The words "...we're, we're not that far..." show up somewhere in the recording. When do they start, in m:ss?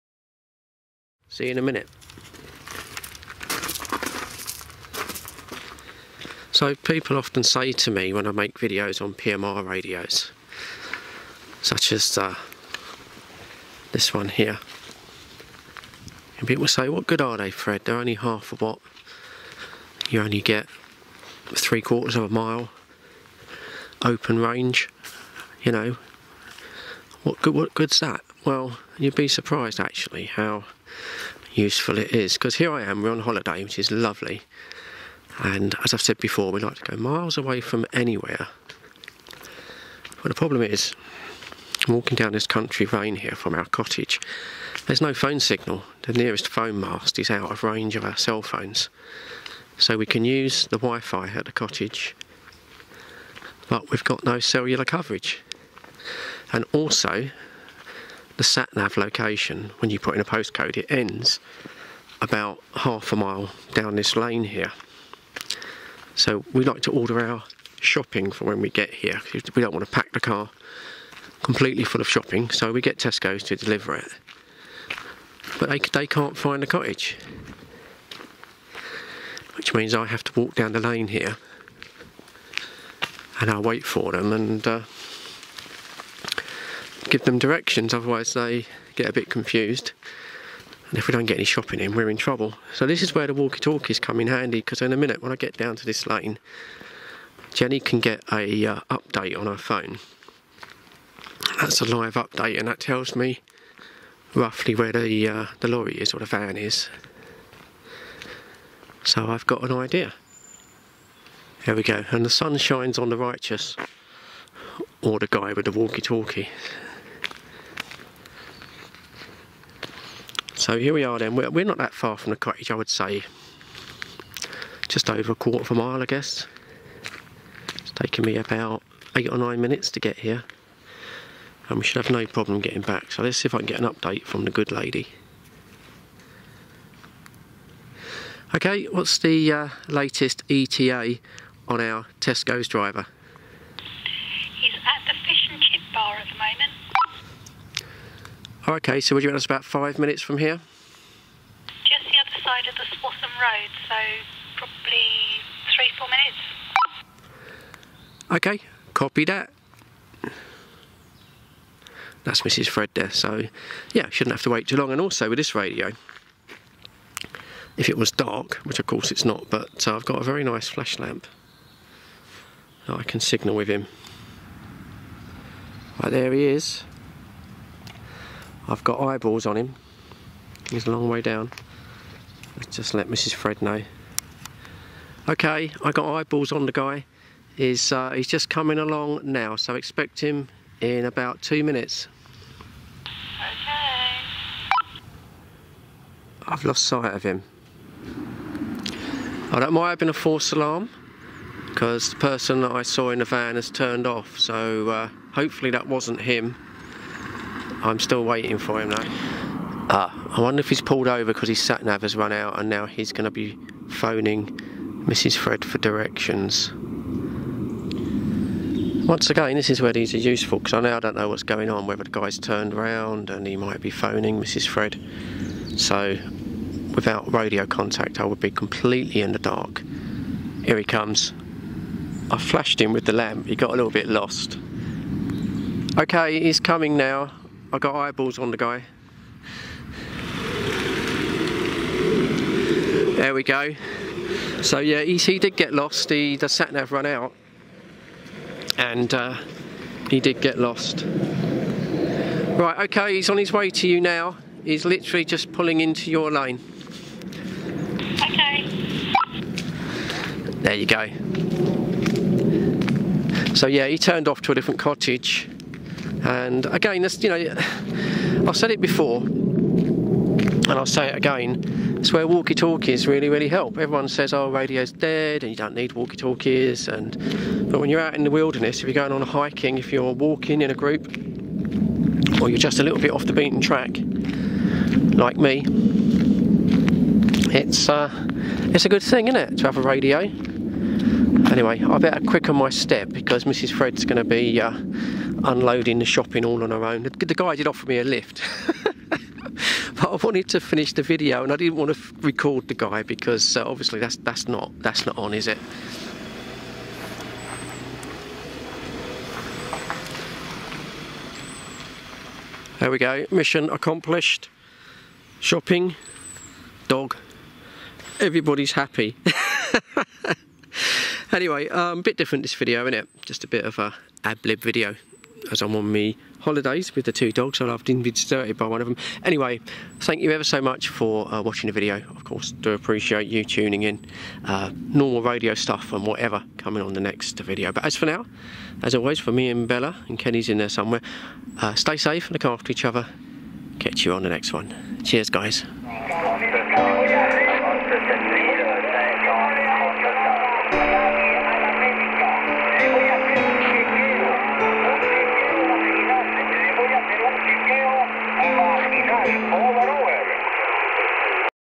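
2:01.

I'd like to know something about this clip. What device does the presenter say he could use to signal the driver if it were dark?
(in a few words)
flash lamp.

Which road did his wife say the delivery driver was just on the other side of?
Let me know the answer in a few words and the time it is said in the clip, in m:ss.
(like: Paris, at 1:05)
Swaffham Road, at 2:32.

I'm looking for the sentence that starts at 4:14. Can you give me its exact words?
He's literally just pulling into your lane.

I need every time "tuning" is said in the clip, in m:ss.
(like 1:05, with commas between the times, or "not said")
5:33.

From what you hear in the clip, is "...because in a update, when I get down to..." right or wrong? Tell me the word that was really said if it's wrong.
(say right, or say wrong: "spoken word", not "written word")
wrong: "minute", not "update".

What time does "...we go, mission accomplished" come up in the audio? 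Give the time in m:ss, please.
5:12.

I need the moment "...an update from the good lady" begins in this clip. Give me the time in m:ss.
2:13.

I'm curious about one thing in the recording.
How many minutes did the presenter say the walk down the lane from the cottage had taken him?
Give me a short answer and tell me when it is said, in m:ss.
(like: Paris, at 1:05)
8 or 9 minutes, at 2:09.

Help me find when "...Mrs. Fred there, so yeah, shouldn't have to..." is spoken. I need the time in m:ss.
2:42.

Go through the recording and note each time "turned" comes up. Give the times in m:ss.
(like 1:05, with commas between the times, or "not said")
3:23, 3:42, 4:23.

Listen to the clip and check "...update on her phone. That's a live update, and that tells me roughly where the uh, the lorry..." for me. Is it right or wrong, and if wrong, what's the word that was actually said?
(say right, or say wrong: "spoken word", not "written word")
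right.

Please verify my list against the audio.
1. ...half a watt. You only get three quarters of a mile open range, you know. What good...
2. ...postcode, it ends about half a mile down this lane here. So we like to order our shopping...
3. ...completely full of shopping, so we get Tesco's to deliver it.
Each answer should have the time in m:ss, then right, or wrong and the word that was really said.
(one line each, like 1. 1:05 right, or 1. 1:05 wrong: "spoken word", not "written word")
1. 0:18 right
2. 1:00 right
3. 1:11 right.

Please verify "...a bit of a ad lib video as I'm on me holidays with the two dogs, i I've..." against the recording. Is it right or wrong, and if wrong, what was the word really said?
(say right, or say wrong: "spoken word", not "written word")
right.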